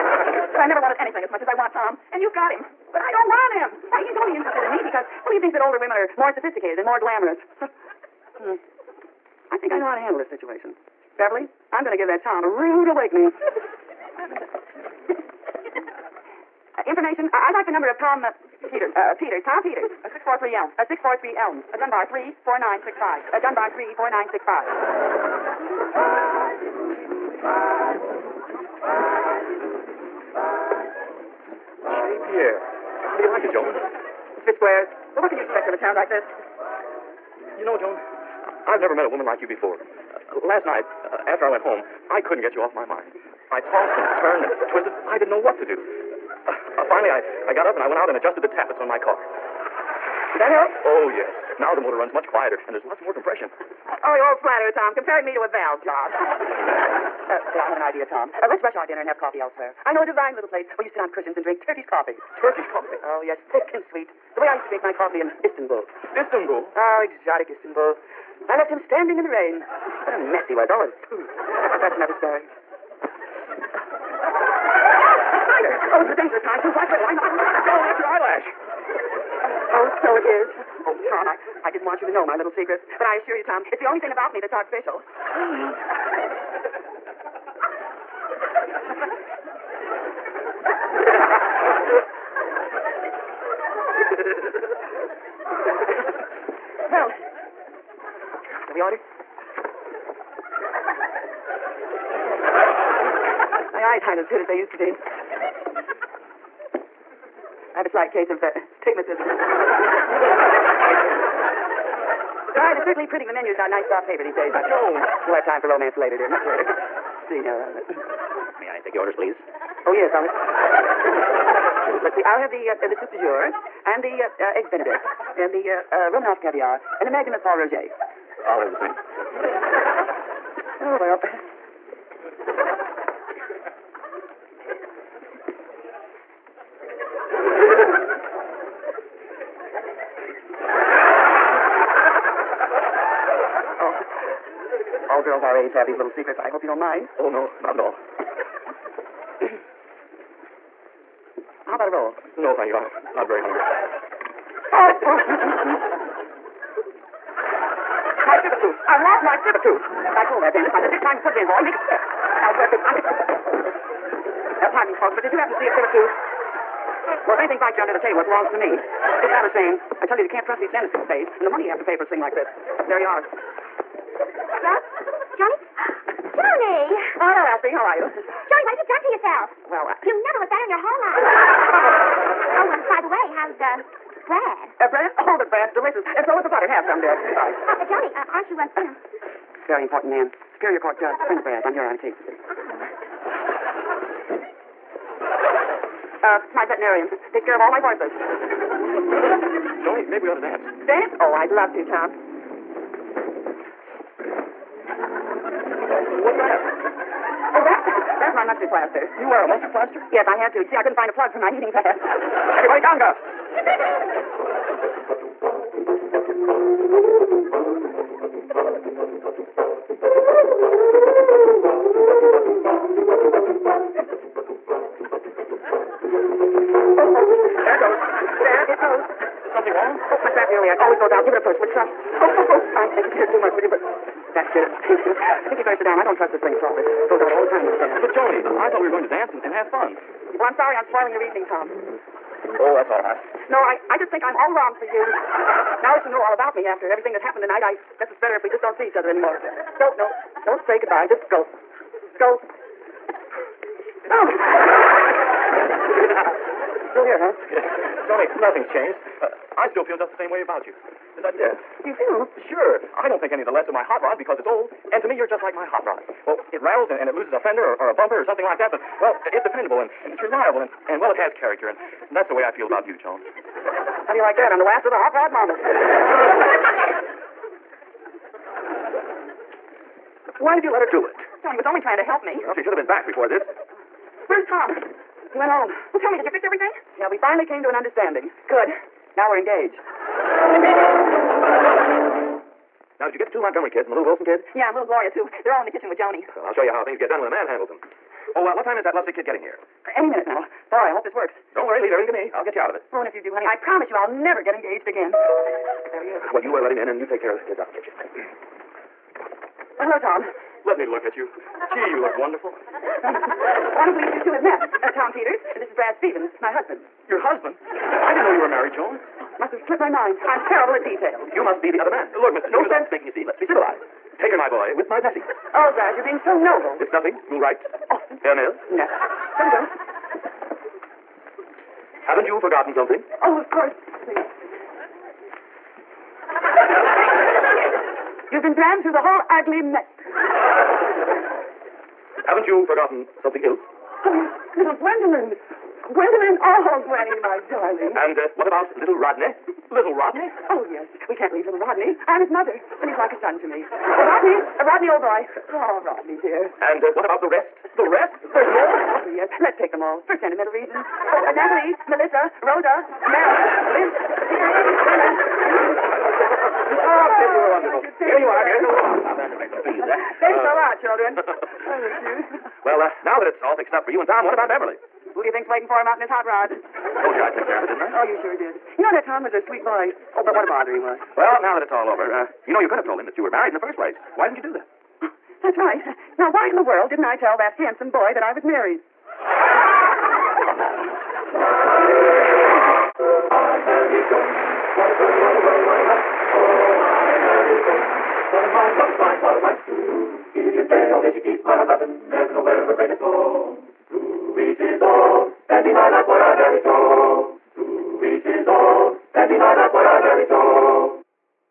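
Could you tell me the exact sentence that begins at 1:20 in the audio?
Oh, Tom, I, I didn't want you to know my little secret.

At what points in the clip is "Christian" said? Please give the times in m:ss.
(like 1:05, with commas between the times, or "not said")
not said.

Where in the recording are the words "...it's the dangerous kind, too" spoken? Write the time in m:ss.
1:16.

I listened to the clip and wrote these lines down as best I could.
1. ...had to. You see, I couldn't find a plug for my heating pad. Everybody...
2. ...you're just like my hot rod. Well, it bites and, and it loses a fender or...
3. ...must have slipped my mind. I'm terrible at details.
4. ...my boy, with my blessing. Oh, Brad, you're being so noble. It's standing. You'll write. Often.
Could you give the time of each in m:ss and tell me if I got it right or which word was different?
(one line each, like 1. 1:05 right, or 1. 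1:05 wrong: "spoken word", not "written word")
1. 3:30 right
2. 4:25 wrong: "rattles", not "bites"
3. 5:19 right
4. 5:24 wrong: "nothing", not "standing".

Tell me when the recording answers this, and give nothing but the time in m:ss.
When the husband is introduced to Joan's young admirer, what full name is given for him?
5:15.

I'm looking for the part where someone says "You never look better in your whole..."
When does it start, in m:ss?
3:00.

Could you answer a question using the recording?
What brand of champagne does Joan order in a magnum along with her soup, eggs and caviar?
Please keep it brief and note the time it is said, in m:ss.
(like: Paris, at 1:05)
Pol Roger, at 2:07.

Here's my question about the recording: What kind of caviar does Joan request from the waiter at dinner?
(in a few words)
Romanoff.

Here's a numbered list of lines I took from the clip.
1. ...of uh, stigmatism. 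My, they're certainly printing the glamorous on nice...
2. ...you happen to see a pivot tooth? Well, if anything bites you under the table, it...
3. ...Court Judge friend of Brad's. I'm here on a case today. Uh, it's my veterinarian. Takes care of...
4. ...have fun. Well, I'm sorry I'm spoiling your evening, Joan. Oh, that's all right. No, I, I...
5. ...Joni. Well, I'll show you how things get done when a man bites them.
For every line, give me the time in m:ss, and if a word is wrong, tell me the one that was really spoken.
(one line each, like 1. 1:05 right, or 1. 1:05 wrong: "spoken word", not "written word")
1. 1:48 wrong: "menus", not "glamorous"
2. 2:45 right
3. 3:10 right
4. 3:59 wrong: "Tom", not "Joan"
5. 4:55 wrong: "handles", not "bites".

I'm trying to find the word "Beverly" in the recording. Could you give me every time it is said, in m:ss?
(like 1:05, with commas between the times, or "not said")
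0:11, 6:14.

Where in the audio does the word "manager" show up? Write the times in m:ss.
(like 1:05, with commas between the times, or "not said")
not said.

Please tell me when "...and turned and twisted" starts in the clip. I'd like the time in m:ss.
0:43.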